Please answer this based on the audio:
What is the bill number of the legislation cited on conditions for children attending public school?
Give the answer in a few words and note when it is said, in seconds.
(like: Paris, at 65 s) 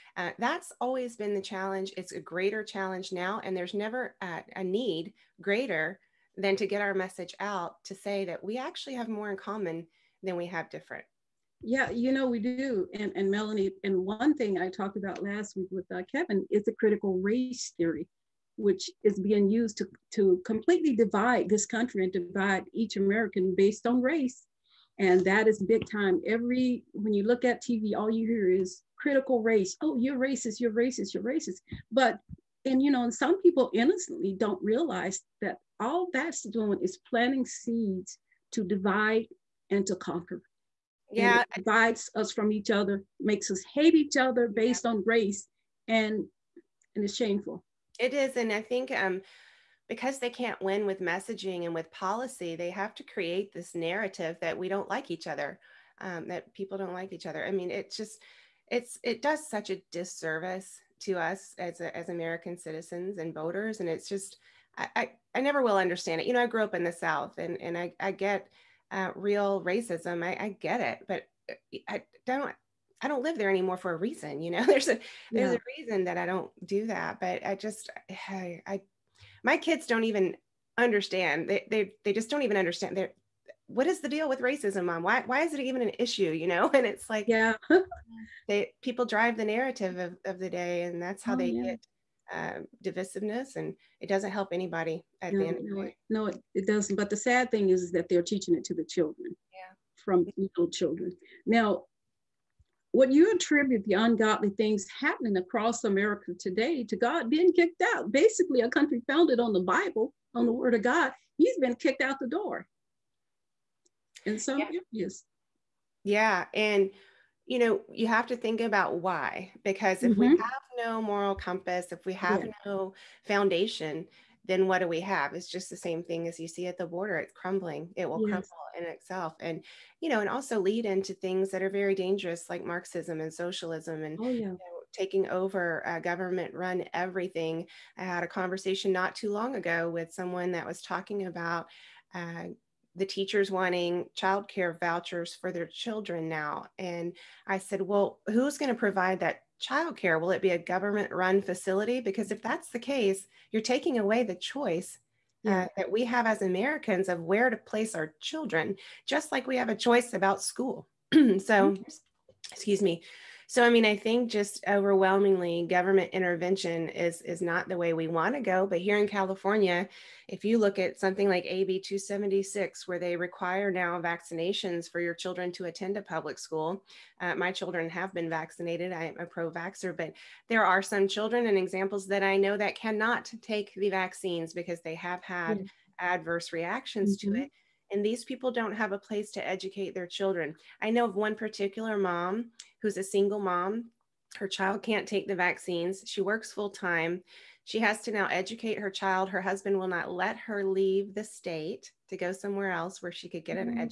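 AB 276, at 171 s.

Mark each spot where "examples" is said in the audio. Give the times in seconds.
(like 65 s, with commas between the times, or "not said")
181 s.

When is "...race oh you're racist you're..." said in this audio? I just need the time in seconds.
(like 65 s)
29 s.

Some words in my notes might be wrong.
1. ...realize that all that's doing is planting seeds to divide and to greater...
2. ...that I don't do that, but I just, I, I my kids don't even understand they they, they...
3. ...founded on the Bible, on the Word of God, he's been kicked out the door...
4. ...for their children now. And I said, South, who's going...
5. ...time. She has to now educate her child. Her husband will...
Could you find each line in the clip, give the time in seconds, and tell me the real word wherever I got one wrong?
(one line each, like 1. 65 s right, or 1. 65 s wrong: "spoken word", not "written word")
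1. 34 s wrong: "conquer", not "greater"
2. 76 s right
3. 109 s right
4. 145 s wrong: "Well", not "South"
5. 196 s right.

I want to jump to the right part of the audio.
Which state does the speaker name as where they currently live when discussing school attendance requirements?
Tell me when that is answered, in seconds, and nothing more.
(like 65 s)
169 s.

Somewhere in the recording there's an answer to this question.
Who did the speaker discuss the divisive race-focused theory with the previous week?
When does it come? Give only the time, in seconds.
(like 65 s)
16 s.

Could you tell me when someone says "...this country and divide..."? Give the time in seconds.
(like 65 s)
21 s.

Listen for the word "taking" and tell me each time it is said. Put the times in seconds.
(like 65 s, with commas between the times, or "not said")
134 s, 153 s.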